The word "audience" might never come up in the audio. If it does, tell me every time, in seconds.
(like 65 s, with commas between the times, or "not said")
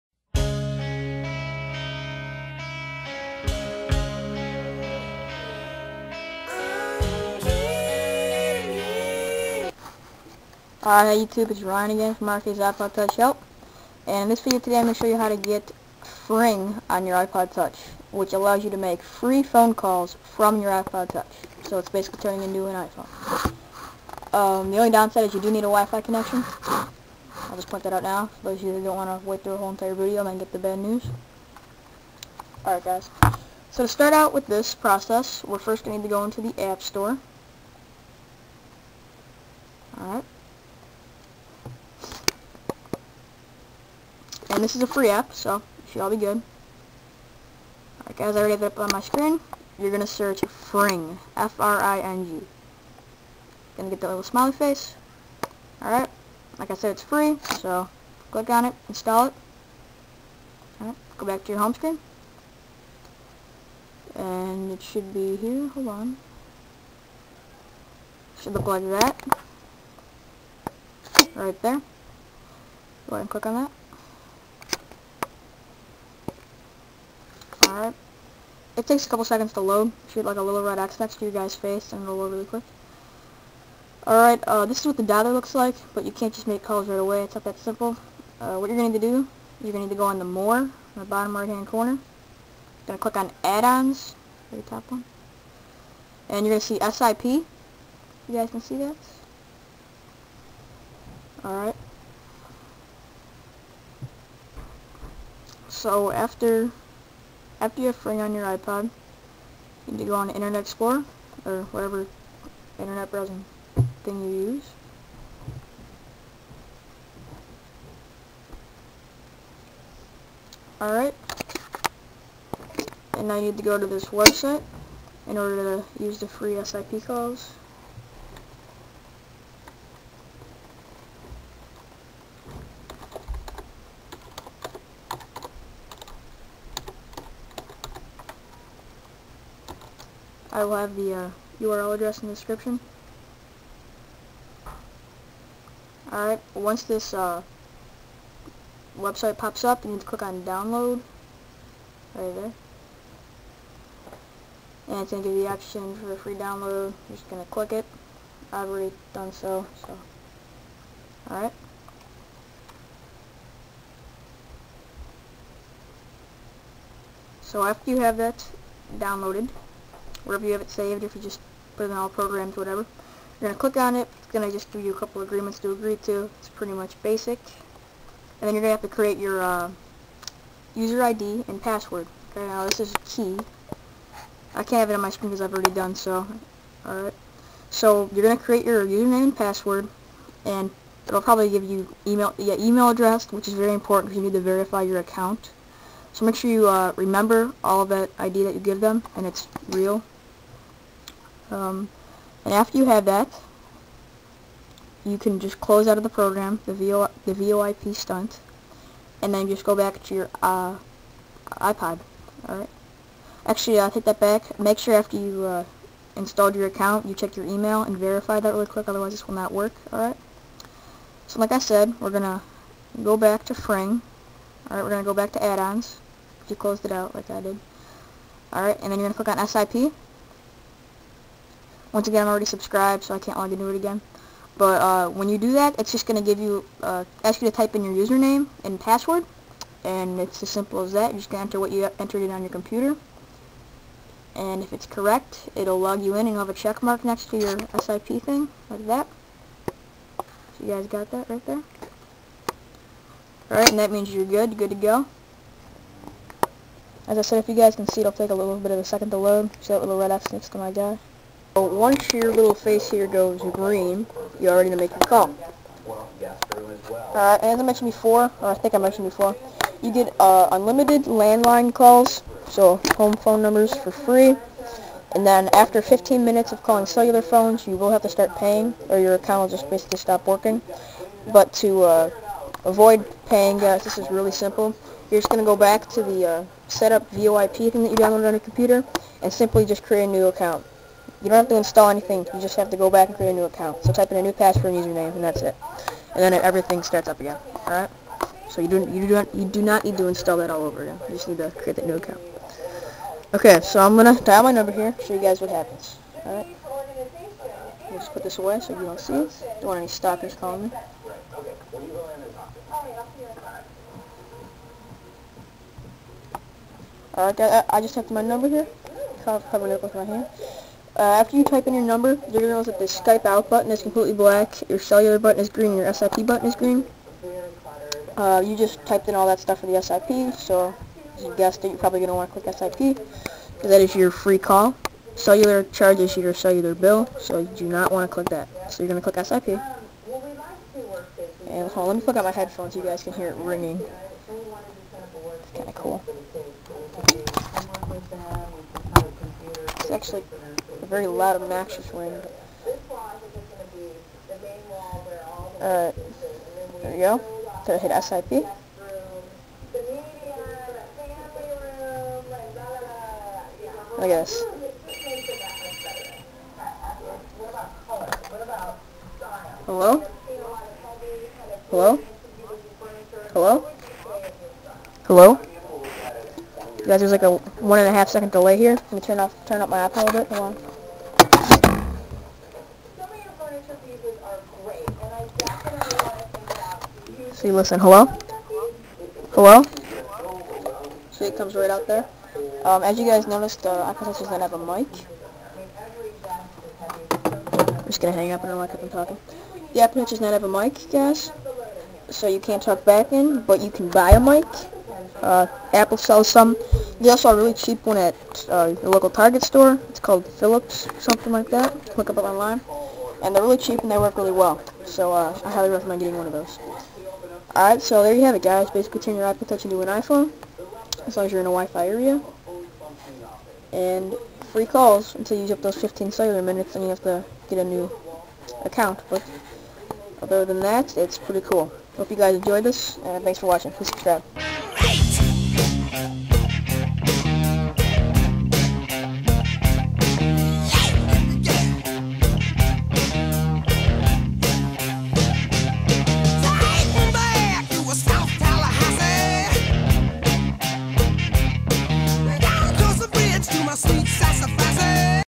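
not said.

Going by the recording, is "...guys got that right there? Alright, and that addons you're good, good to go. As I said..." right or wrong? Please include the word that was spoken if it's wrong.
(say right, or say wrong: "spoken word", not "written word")
wrong: "means", not "addons".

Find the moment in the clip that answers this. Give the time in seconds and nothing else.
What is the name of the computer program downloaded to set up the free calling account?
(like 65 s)
207 s.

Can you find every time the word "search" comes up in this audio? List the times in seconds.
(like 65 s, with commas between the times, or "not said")
50 s.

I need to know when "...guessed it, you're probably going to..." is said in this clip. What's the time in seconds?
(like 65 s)
331 s.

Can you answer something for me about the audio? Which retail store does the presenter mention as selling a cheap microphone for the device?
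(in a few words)
Target.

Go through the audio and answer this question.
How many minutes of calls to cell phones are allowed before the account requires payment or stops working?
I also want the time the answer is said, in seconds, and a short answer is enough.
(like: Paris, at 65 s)
15, at 275 s.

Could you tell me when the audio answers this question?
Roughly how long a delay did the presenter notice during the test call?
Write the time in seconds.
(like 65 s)
377 s.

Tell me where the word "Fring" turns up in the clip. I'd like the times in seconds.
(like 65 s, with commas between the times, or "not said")
16 s, 50 s, 108 s, 223 s.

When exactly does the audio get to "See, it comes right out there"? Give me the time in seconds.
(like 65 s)
391 s.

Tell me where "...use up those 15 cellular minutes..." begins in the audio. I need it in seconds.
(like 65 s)
425 s.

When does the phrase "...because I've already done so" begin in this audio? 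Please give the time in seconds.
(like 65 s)
185 s.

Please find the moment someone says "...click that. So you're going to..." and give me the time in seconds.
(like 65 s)
338 s.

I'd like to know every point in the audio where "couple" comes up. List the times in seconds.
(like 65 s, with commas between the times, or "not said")
79 s, 174 s.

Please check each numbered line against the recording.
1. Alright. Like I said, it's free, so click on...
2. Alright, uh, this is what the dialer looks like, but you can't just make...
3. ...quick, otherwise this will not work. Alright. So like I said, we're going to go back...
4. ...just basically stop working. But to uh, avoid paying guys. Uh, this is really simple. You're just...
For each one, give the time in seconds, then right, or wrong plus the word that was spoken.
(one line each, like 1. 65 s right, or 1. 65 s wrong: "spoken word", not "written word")
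1. 55 s right
2. 84 s right
3. 218 s right
4. 279 s right.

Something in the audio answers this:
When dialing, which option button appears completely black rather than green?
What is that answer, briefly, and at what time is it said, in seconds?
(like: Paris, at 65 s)
Skype out, at 322 s.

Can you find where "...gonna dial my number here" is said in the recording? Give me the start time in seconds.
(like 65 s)
303 s.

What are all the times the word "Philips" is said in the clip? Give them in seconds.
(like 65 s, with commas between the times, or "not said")
410 s.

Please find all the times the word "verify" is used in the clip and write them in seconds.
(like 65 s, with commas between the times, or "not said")
194 s, 217 s.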